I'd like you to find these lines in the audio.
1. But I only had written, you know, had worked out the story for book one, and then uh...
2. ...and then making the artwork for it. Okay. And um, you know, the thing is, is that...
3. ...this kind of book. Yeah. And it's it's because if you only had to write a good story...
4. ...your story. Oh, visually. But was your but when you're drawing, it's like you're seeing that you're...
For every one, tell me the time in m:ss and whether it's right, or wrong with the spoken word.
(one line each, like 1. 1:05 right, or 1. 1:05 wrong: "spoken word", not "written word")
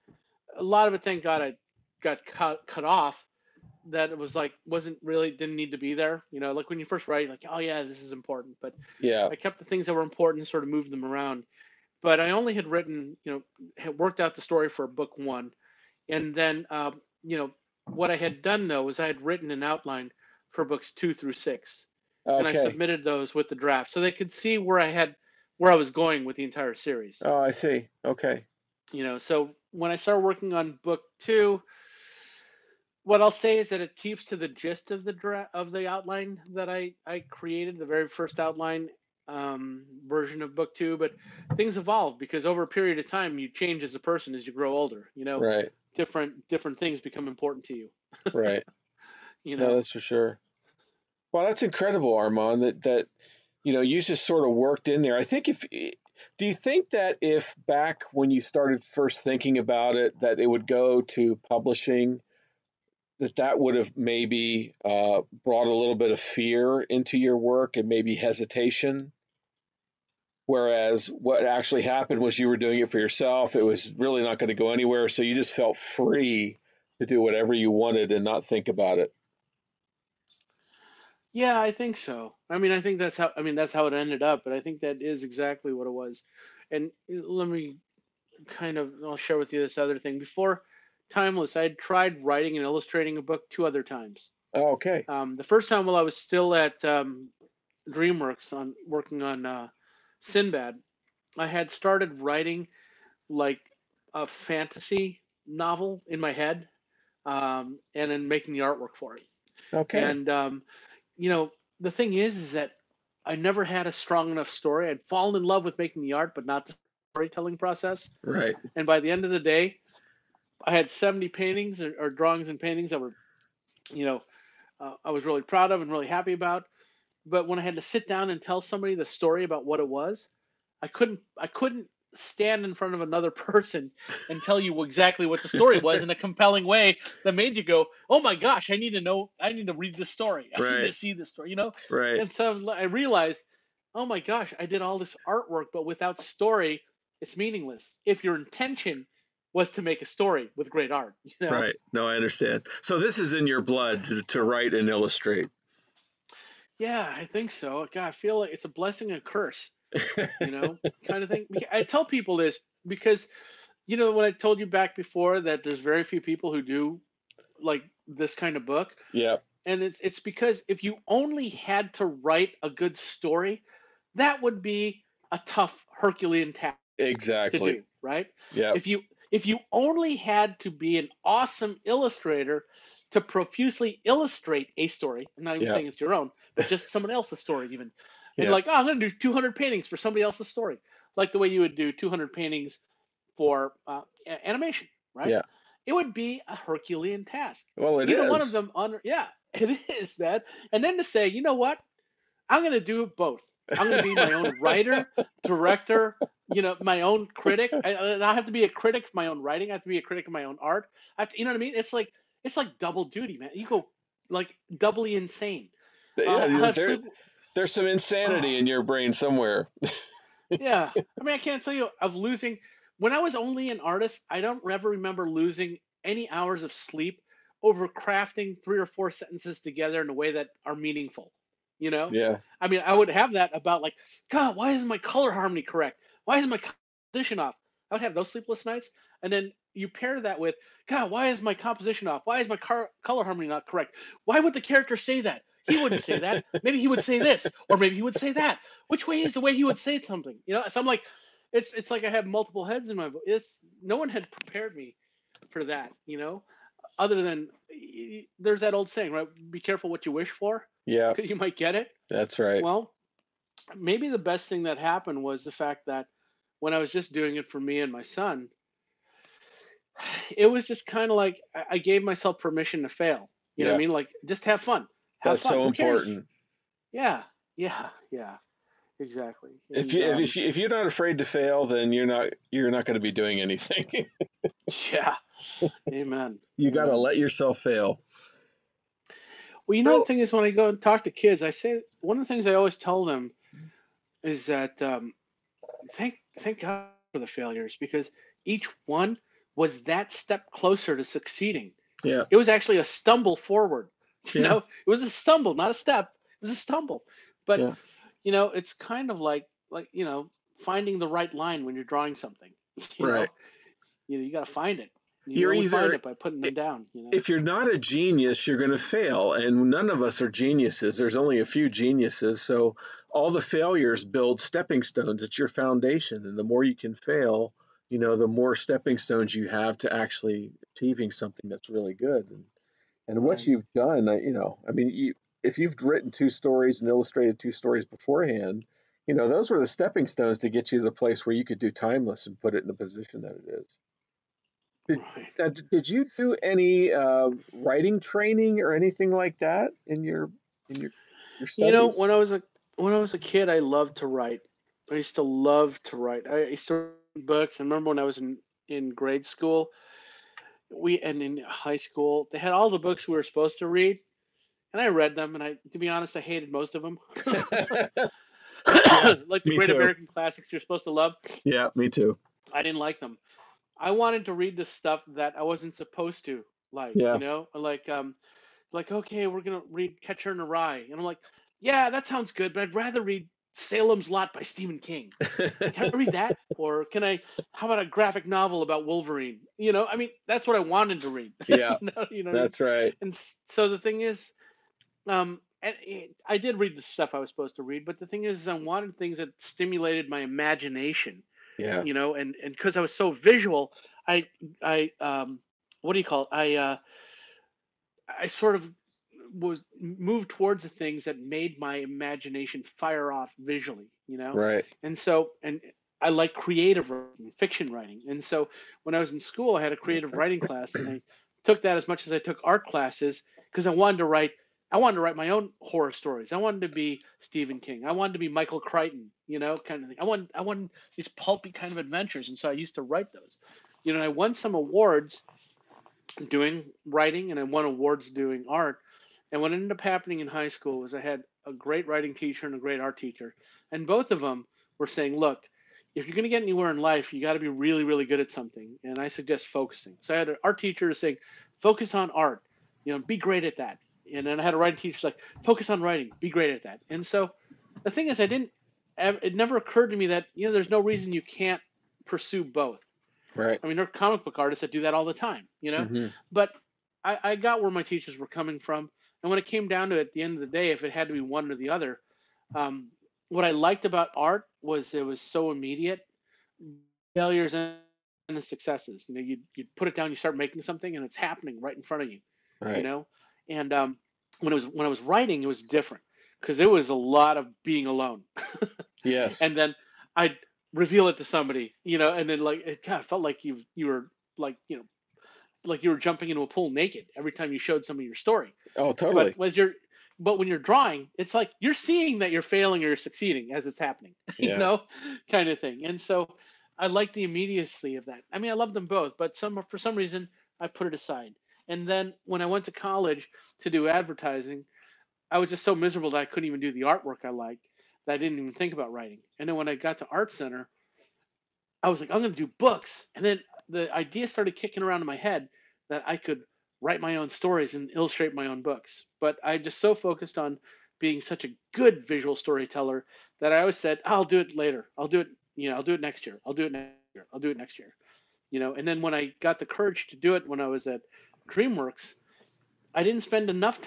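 1. 0:12 right
2. 1:47 right
3. 2:48 right
4. 8:17 wrong: "totally", not "visually".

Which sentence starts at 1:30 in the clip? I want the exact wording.
Before Timeless, I had tried writing and illustrating a book two other times.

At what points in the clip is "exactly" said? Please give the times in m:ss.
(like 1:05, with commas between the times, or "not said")
1:25, 2:14, 2:56, 4:38.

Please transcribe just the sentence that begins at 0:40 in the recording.
But things evolve because over a period of time, you change as a person as you grow older.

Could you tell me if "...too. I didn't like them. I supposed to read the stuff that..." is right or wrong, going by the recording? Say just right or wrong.
wrong.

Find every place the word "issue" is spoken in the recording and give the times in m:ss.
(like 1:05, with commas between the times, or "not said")
not said.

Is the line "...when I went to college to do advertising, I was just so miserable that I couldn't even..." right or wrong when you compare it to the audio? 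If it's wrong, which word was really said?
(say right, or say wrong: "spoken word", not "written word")
right.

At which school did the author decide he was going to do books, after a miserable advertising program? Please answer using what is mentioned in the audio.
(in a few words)
Art Center.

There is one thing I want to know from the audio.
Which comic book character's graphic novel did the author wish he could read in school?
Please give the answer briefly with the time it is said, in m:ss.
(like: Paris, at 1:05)
Wolverine, at 6:28.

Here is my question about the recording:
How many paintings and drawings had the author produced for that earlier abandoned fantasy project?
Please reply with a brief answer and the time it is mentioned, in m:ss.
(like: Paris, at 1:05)
70, at 2:00.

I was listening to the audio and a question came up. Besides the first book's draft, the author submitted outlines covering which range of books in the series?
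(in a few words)
Books 2 through 6.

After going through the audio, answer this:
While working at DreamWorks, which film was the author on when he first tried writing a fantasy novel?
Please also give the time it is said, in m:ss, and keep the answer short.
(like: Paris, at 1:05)
Sinbad, at 1:40.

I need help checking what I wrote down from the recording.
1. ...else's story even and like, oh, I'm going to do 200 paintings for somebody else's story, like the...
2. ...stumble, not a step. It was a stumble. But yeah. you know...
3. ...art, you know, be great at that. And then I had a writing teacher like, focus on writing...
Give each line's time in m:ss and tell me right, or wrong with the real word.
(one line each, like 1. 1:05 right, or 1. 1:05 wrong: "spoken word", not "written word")
1. 3:07 right
2. 5:05 right
3. 7:32 right.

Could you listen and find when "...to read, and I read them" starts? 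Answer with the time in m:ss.
6:03.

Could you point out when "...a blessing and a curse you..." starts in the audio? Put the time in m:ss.
2:38.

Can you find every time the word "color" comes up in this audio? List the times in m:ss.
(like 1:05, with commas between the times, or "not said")
3:54, 4:03.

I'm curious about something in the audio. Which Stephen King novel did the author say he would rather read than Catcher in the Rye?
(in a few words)
Salem's Lot.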